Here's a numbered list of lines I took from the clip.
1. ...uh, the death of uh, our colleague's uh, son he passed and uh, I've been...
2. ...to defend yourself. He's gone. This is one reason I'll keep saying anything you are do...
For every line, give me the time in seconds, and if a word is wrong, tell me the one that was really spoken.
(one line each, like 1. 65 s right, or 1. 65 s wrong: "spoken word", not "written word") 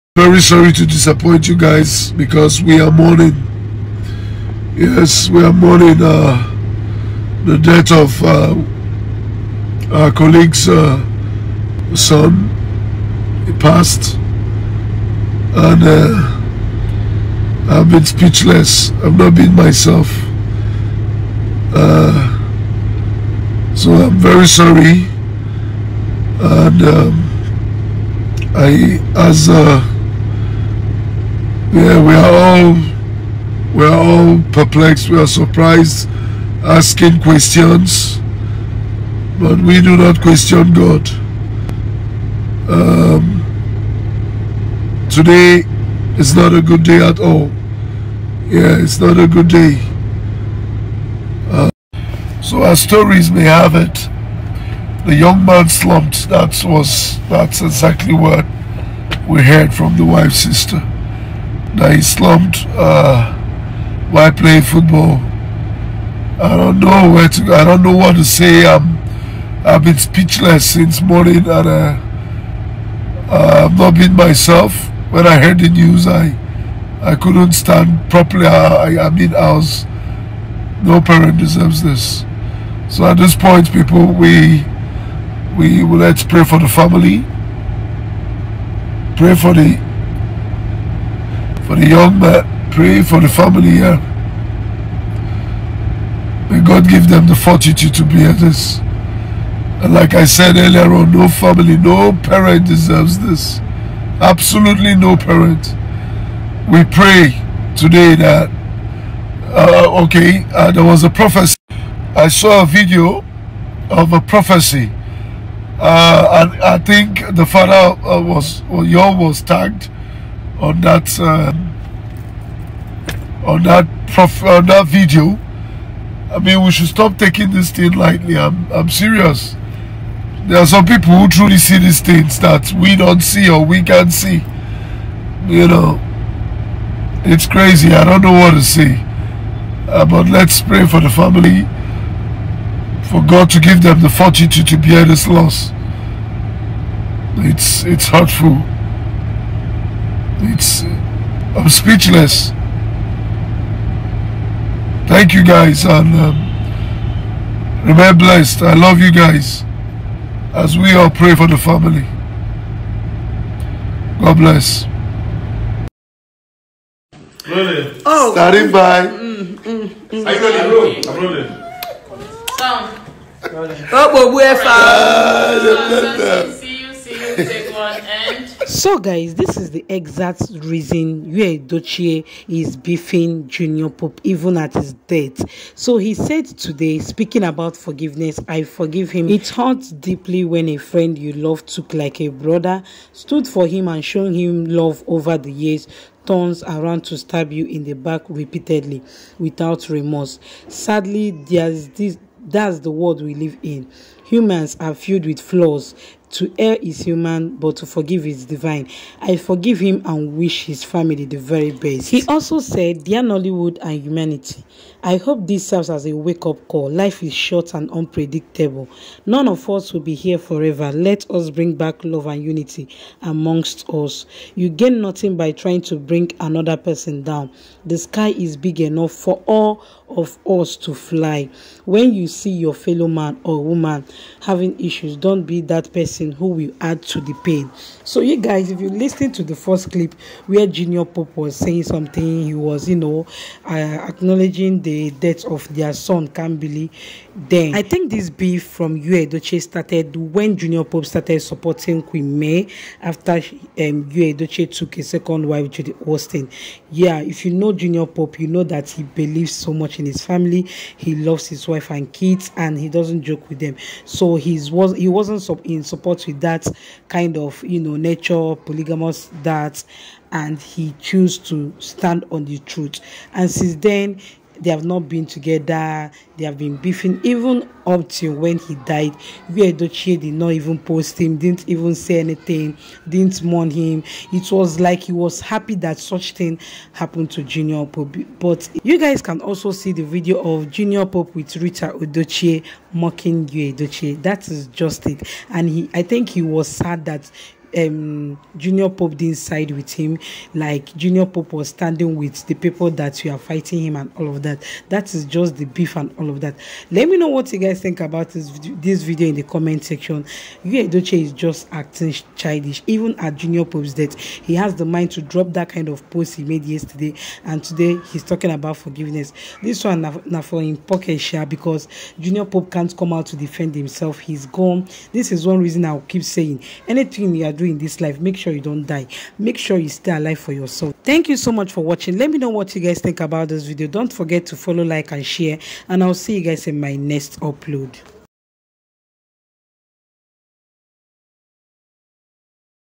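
1. 6 s right
2. 323 s wrong: "himself", not "yourself".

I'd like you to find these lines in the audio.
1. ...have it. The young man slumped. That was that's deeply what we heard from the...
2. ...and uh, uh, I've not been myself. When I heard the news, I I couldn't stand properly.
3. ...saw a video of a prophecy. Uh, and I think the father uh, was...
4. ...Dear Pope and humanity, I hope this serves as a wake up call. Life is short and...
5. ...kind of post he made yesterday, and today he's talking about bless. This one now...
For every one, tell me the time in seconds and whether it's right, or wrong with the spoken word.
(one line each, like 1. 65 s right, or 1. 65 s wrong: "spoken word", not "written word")
1. 53 s wrong: "exactly", not "deeply"
2. 71 s right
3. 112 s right
4. 213 s wrong: "Nollywood", not "Pope"
5. 315 s wrong: "forgiveness", not "bless".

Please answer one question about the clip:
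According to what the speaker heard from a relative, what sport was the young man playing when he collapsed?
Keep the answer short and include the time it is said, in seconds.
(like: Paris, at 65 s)
Football, at 64 s.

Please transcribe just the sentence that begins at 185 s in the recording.
So he said today, speaking about forgiveness, I forgive him.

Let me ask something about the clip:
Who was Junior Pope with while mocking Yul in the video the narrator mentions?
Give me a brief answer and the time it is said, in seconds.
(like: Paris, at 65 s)
Rita Edochie, at 291 s.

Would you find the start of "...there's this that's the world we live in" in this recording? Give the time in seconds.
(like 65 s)
201 s.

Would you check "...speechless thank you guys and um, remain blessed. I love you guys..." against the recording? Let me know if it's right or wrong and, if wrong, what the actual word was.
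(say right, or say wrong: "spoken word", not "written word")
right.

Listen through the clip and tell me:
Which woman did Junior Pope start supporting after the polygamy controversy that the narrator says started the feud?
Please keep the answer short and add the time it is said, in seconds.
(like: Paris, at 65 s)
Queen May, at 252 s.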